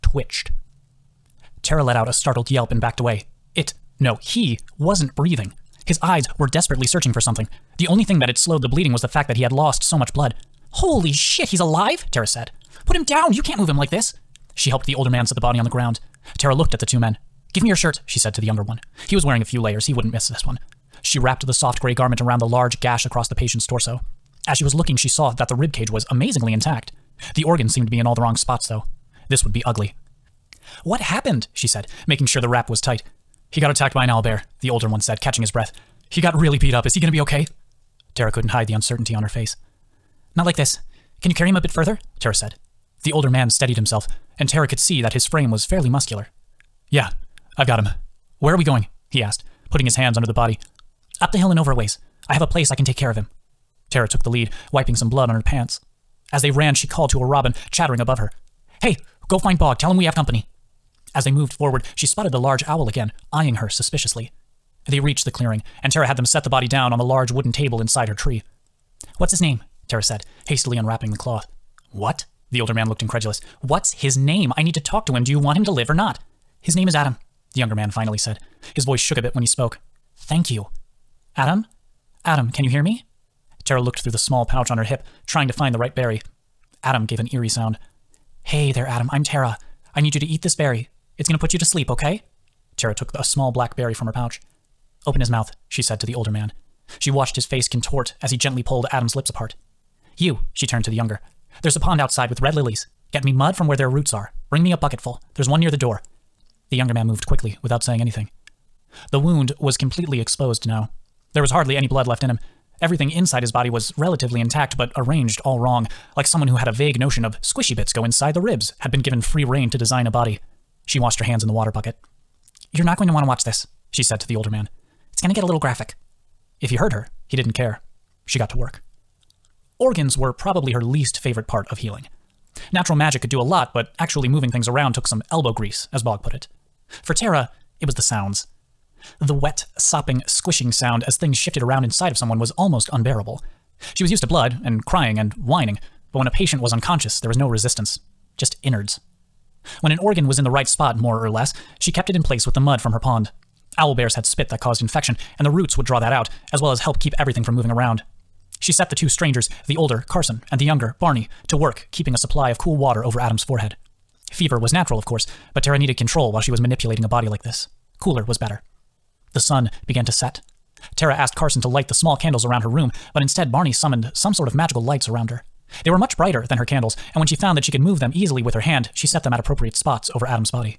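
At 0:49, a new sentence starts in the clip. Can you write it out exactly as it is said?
he asked, putting his hands under the body.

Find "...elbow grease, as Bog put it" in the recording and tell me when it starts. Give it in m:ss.
2:15.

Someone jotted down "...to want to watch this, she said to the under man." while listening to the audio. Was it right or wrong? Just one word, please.
wrong.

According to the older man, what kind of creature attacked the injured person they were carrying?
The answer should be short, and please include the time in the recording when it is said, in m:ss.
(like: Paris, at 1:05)
An owlbear, at 0:34.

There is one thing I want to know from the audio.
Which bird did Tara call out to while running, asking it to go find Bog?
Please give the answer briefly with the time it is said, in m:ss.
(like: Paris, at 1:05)
A robin, at 0:57.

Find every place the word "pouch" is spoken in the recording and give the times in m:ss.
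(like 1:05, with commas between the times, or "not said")
1:24, 1:34.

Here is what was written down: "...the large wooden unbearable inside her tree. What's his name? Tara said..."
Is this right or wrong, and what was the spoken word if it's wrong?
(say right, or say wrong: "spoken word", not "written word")
wrong: "table", not "unbearable".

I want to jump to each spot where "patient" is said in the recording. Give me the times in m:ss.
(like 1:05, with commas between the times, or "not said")
0:23, 2:26.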